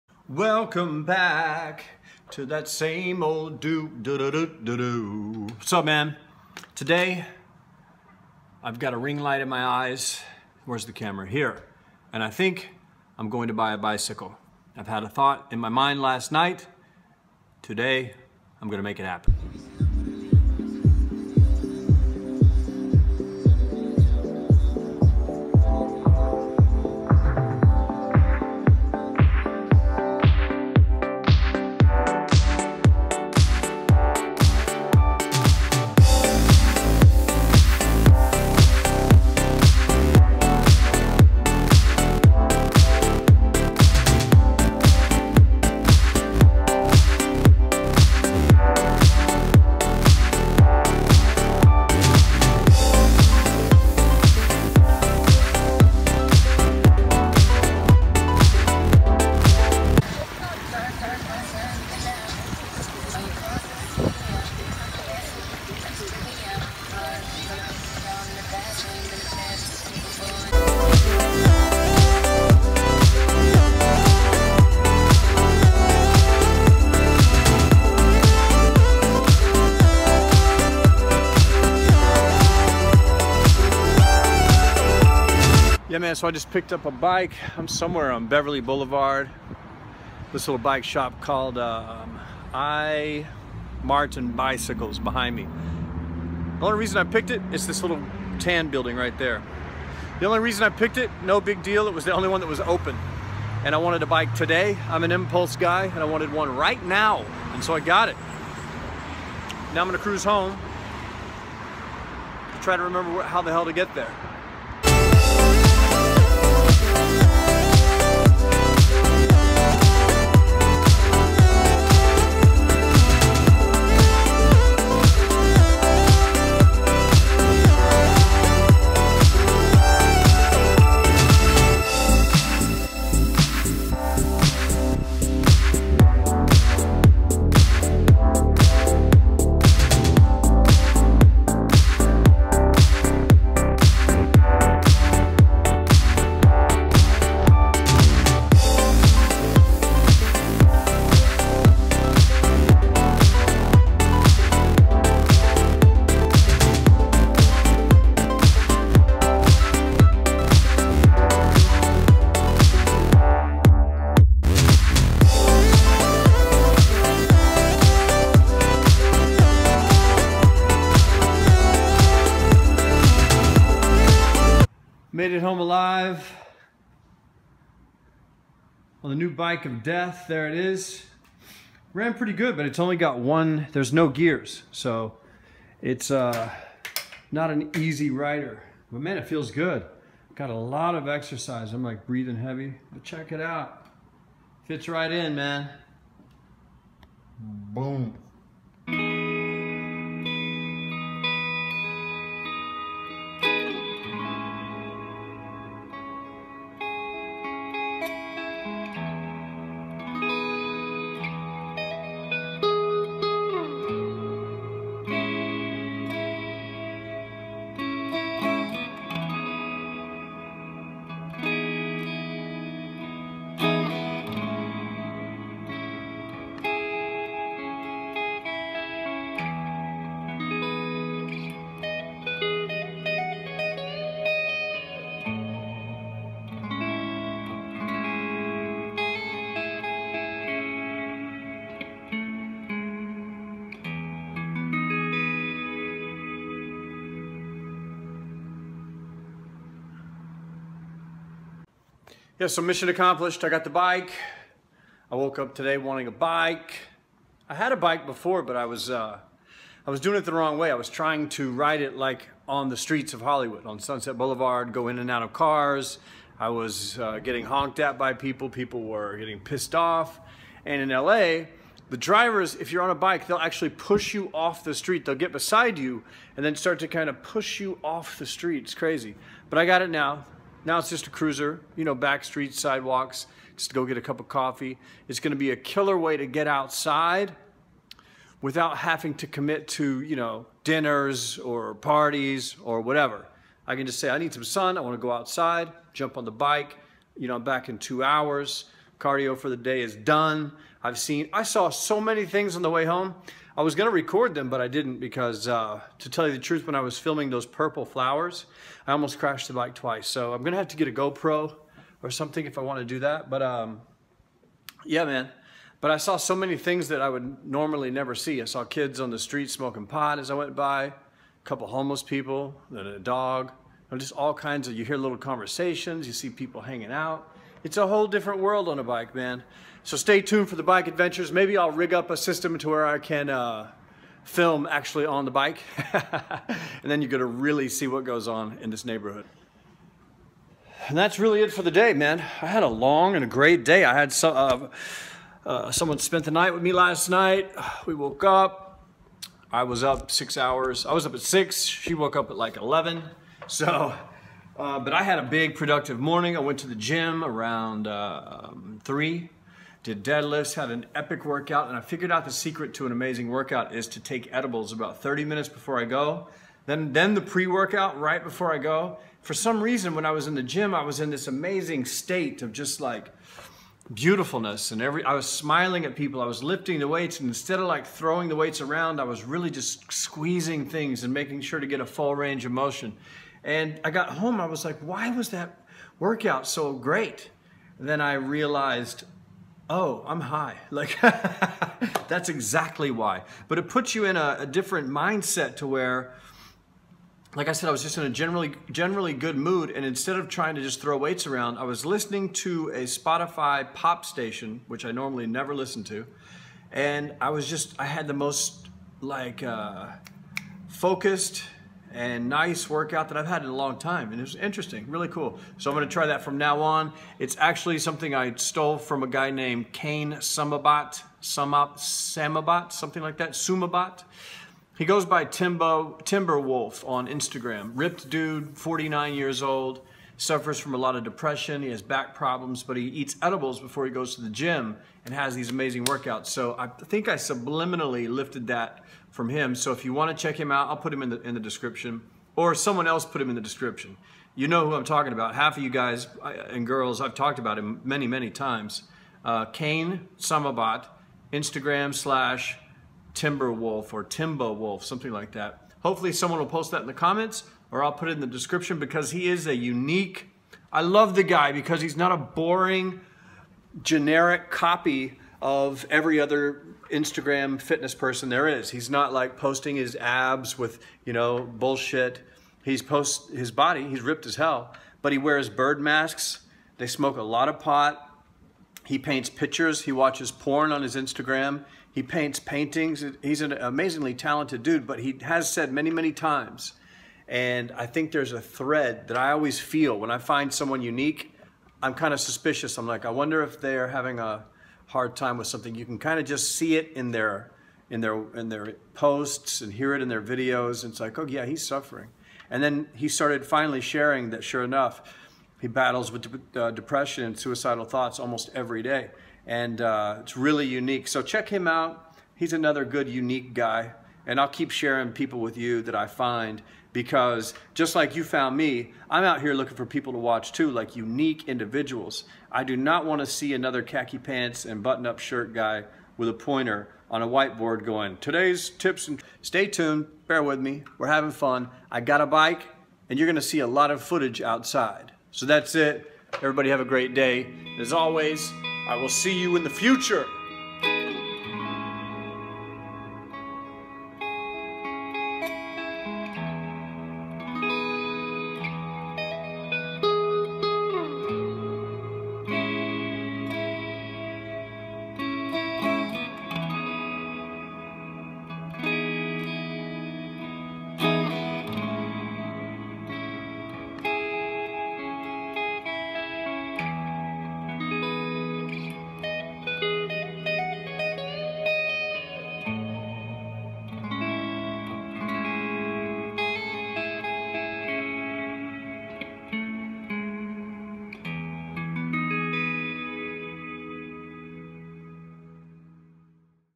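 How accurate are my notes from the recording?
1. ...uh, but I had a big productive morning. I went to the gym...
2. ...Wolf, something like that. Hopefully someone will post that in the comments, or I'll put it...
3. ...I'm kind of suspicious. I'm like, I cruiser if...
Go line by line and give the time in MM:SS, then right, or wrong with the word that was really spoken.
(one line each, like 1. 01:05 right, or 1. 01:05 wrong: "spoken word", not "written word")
1. 05:54 right
2. 07:34 right
3. 08:11 wrong: "wonder", not "cruiser".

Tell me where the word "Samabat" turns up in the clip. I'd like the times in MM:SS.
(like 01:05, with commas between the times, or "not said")
07:01, 07:30.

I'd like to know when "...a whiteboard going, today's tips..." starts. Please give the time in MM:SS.
08:47.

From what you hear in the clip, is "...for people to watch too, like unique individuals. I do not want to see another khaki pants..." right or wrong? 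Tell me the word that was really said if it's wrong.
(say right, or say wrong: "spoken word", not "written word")
right.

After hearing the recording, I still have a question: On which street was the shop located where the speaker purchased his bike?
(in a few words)
Beverly Boulevard.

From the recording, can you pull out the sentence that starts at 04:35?
They'll get beside you and then start to kind of push you off the street.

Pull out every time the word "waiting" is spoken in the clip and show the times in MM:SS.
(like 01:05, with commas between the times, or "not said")
not said.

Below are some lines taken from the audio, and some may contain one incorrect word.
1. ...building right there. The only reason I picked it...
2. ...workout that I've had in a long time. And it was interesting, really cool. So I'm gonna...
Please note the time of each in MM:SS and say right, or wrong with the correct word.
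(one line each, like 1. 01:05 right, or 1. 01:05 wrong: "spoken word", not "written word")
1. 01:38 right
2. 06:52 right.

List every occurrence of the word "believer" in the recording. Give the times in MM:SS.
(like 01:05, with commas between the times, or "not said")
not said.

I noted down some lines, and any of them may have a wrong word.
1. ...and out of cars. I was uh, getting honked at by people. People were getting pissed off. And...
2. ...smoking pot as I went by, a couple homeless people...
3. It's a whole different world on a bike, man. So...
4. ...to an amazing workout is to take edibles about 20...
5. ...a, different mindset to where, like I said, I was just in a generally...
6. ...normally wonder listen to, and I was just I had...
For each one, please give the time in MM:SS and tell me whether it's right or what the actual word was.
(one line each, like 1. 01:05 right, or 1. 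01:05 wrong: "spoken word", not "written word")
1. 04:24 right
2. 05:19 right
3. 05:27 right
4. 06:02 wrong: "30", not "20"
5. 06:34 right
6. 06:44 wrong: "never", not "wonder".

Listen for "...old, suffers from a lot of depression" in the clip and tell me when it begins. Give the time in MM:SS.
07:09.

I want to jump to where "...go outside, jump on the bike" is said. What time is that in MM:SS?
04:55.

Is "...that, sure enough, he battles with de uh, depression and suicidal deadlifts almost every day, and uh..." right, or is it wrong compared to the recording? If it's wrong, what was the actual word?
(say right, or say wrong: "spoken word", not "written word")
wrong: "thoughts", not "deadlifts".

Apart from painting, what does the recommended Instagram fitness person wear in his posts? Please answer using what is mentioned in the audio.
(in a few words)
Bird masks.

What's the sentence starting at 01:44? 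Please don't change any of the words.
I'm an impulse guy and I wanted one right now.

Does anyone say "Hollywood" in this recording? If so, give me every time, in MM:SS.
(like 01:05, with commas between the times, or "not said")
04:23.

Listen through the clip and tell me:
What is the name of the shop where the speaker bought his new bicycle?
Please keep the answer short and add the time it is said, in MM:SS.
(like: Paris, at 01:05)
I Martin Bicycles, at 01:32.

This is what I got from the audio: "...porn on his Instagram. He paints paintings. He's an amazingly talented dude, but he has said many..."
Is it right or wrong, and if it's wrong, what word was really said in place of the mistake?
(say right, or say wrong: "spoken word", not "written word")
right.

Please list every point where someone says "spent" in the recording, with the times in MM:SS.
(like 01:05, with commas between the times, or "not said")
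05:45.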